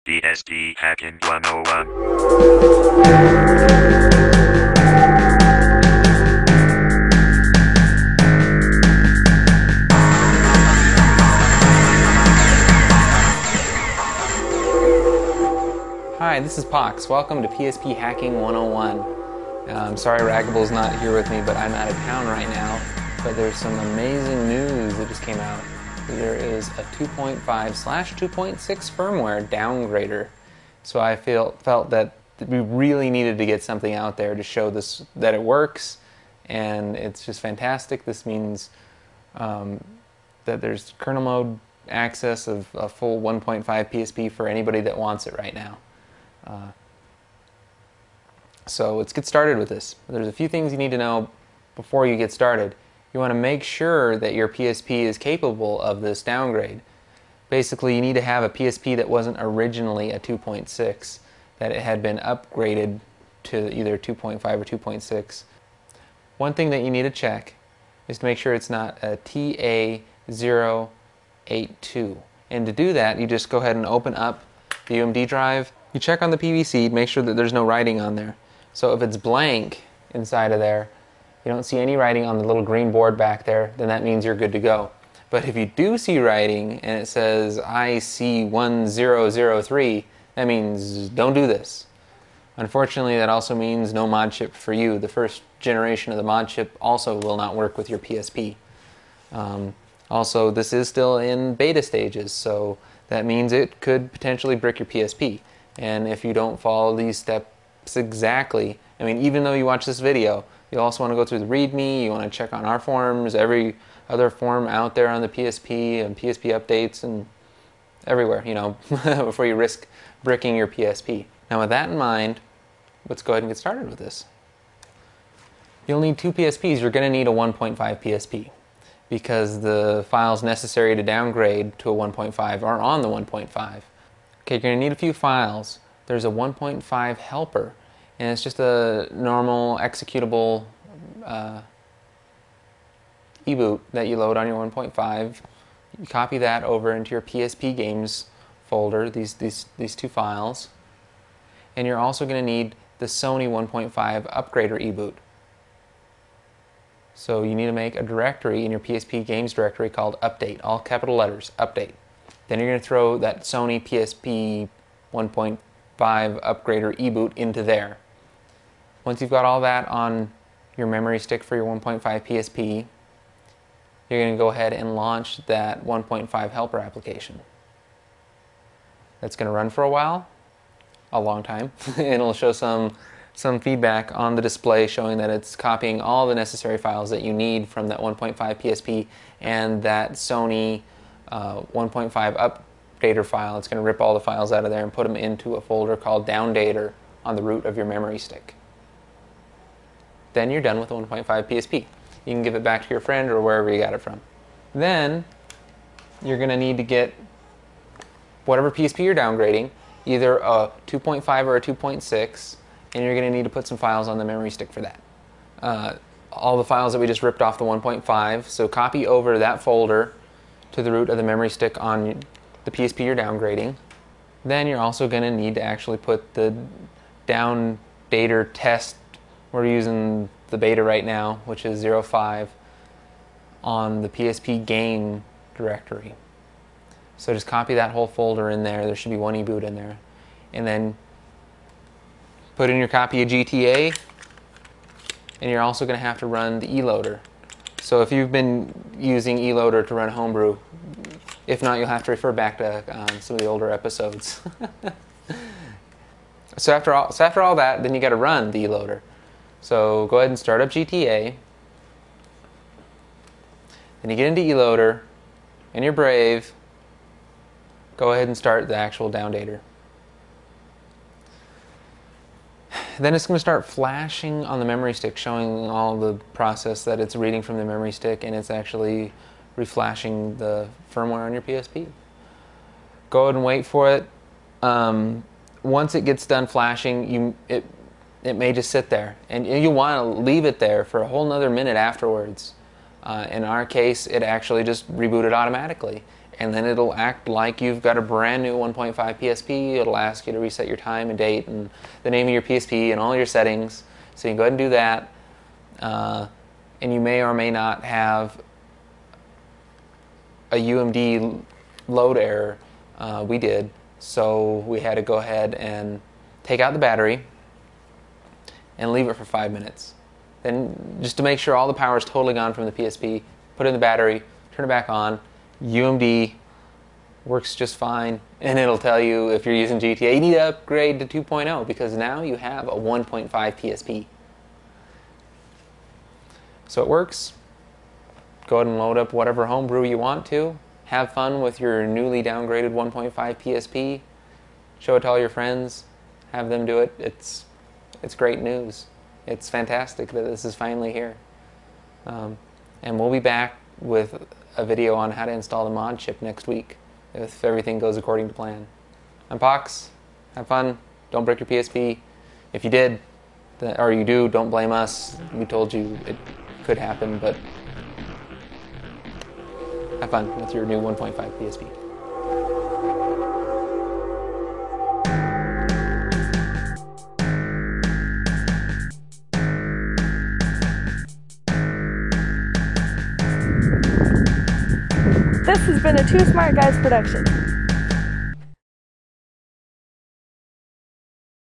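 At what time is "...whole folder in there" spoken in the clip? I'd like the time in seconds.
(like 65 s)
237 s.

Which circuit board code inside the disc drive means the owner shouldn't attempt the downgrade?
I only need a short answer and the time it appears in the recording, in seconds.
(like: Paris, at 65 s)
IC1003, at 87 s.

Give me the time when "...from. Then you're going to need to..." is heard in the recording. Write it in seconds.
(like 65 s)
204 s.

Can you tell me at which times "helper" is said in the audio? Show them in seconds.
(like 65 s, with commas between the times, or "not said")
137 s, 176 s.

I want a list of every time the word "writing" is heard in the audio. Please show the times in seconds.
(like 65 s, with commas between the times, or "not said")
77 s, 81 s, 86 s.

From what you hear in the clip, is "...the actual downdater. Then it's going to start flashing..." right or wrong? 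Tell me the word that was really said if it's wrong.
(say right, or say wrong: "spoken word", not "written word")
right.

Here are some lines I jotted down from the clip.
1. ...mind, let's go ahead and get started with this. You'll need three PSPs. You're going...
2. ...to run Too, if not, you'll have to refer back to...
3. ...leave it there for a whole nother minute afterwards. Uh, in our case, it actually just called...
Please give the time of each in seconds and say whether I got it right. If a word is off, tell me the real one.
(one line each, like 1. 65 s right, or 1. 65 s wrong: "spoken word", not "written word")
1. 121 s wrong: "two", not "three"
2. 249 s wrong: "Homebrew", not "Too"
3. 290 s wrong: "rebooted", not "called".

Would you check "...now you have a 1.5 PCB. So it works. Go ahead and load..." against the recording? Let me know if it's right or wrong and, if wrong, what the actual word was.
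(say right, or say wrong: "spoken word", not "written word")
wrong: "PSP", not "PCB".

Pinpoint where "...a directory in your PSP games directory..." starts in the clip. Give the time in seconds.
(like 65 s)
157 s.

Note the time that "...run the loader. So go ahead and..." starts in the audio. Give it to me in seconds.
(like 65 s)
258 s.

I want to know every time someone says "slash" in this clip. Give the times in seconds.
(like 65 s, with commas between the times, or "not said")
27 s.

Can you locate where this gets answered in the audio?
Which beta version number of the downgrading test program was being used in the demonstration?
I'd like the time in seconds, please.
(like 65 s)
231 s.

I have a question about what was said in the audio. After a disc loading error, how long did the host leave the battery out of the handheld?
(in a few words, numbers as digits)
5 minutes.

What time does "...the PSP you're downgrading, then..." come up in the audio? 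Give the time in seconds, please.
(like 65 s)
222 s.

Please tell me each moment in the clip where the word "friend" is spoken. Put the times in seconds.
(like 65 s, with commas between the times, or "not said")
203 s, 345 s.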